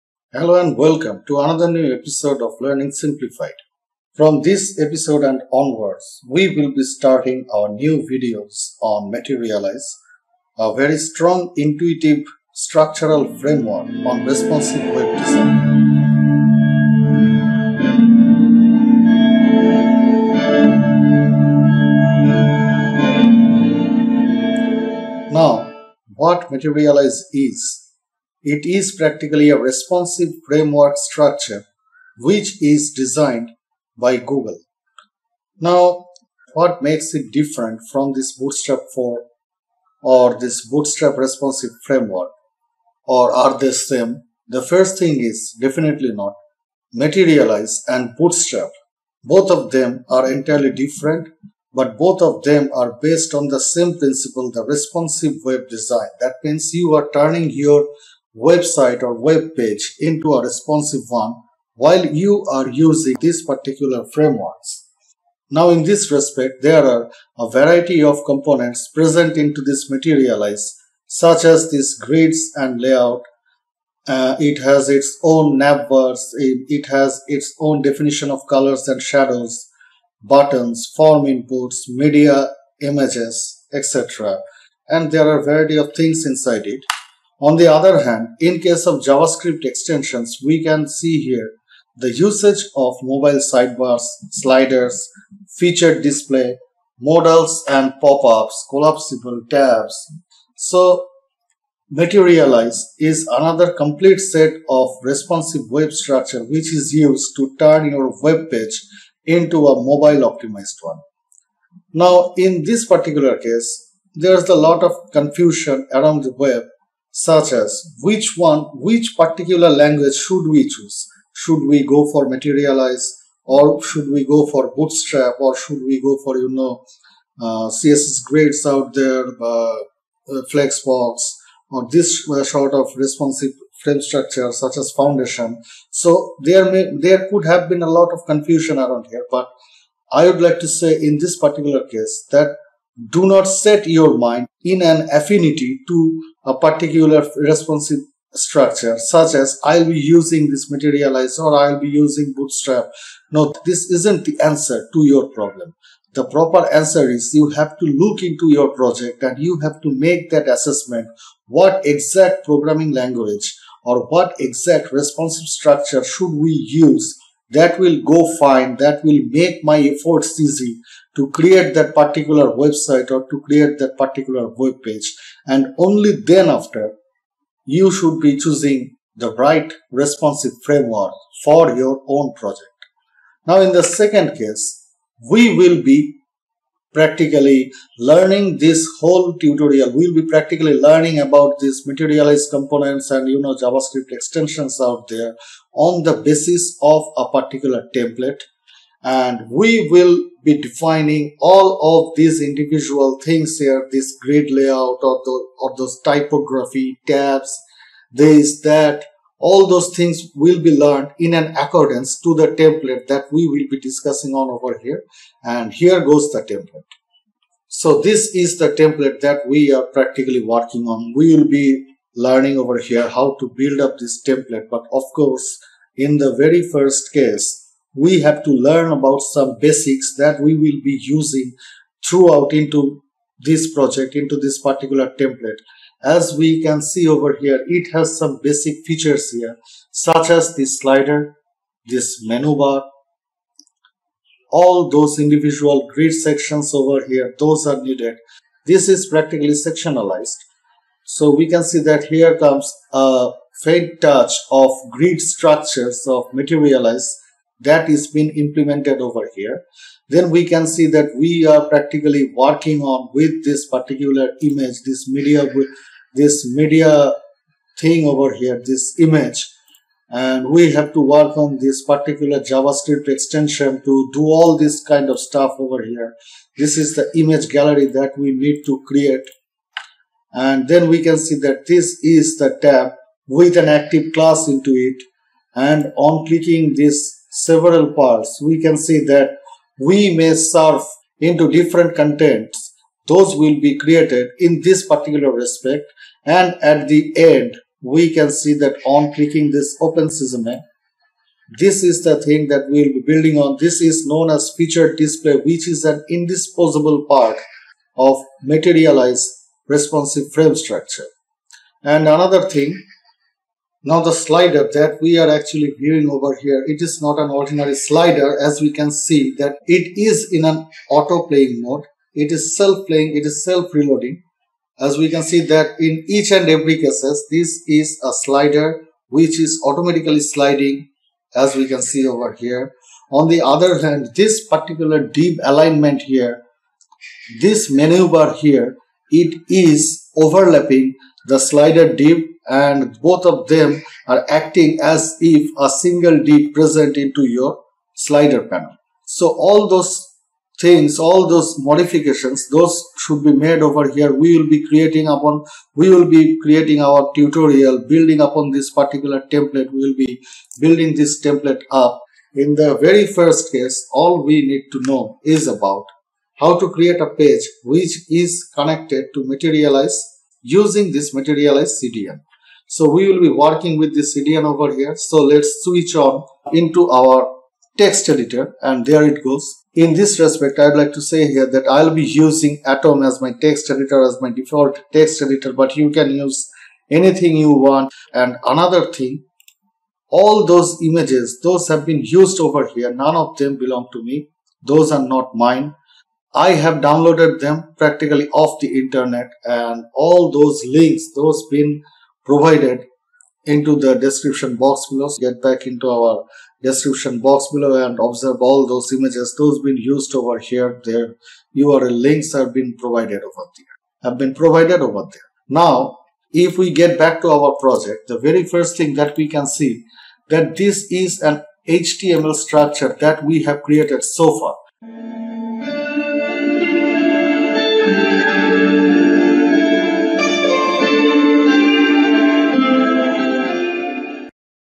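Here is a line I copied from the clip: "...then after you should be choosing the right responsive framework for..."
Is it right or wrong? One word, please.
right.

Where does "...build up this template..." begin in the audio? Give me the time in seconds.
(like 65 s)
223 s.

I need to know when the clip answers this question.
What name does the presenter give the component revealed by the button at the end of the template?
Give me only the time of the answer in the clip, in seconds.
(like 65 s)
304 s.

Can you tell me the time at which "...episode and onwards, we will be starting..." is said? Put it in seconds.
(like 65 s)
4 s.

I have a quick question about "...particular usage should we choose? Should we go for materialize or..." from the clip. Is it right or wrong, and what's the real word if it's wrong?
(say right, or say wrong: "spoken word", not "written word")
wrong: "language", not "usage".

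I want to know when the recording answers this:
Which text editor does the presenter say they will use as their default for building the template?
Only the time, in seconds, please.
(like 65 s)
382 s.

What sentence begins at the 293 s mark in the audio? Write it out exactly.
Those will be created in this particular respect.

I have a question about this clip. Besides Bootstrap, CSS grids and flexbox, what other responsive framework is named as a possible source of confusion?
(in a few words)
Foundation.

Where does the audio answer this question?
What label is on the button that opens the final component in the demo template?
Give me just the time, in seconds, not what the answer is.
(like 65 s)
299 s.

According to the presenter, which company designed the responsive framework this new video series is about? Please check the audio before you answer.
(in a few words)
Google.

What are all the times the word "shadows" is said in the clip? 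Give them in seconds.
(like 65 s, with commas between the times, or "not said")
79 s.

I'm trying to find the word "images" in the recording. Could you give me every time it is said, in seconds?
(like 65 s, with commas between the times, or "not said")
82 s, 264 s, 268 s, 277 s, 390 s, 408 s.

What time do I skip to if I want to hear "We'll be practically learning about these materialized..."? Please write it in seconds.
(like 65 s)
189 s.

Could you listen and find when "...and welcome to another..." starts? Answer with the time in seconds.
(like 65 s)
0 s.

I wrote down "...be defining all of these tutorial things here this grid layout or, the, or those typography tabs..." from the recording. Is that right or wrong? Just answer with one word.
wrong.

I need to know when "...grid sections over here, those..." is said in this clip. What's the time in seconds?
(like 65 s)
245 s.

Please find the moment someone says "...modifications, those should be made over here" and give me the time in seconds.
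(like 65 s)
351 s.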